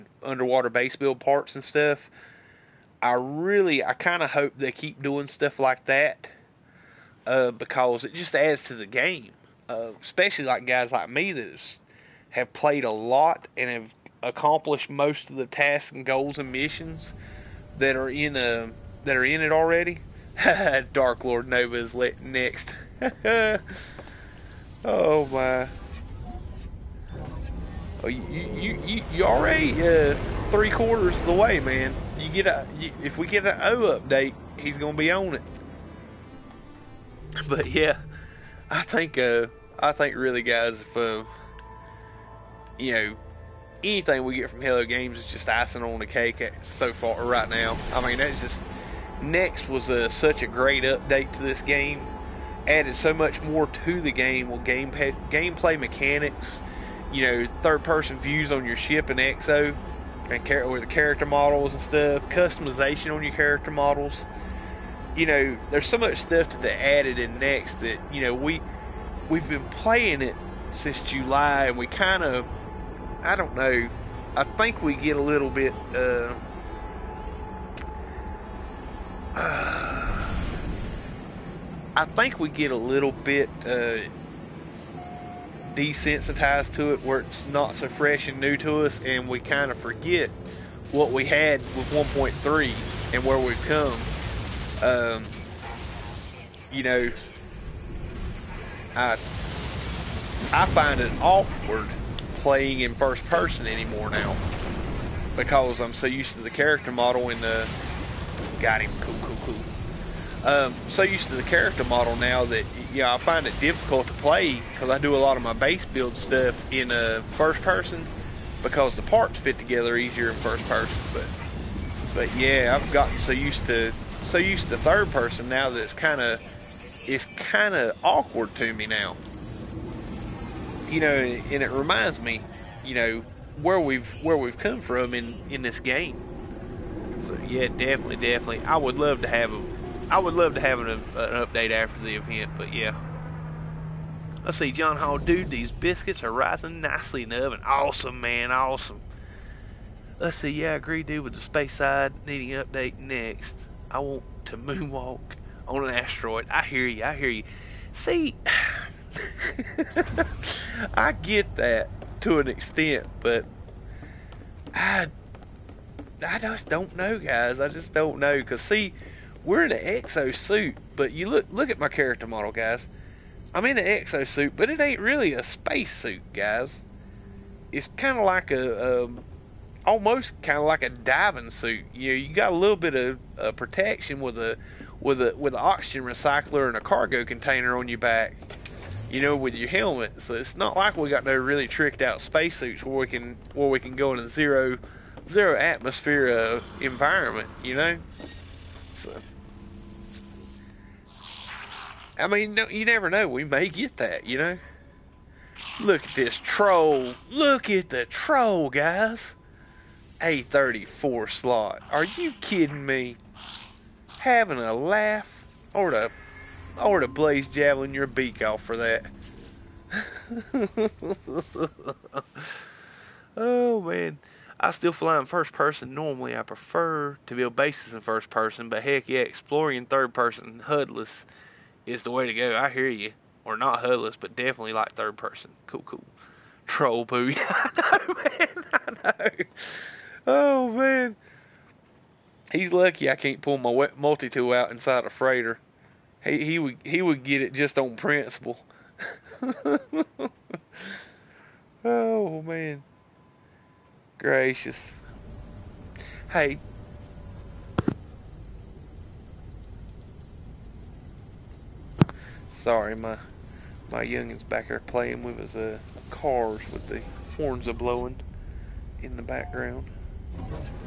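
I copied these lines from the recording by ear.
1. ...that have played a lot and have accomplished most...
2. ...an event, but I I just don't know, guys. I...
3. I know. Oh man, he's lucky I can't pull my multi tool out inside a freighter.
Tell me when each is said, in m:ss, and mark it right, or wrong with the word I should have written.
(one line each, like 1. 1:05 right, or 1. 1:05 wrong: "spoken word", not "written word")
1. 0:11 right
2. 2:42 wrong: "extent", not "event"
3. 3:58 right.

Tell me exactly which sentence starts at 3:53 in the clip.
Or not HUDless, but definitely like third person.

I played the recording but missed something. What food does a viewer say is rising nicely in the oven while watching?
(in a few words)
Biscuits.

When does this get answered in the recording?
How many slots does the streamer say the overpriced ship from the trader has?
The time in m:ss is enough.
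3:30.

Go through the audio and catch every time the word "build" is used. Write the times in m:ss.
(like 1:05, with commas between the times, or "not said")
0:00, 1:55, 3:47.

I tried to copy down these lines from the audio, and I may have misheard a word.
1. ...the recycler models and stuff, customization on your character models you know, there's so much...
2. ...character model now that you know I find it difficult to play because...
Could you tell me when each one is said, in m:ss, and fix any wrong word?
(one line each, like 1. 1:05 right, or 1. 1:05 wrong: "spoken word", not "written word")
1. 1:00 wrong: "character", not "recycler"
2. 1:51 right.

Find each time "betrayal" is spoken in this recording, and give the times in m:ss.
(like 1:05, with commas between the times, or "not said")
not said.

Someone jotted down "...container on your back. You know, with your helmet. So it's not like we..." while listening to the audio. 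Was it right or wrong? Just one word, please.
right.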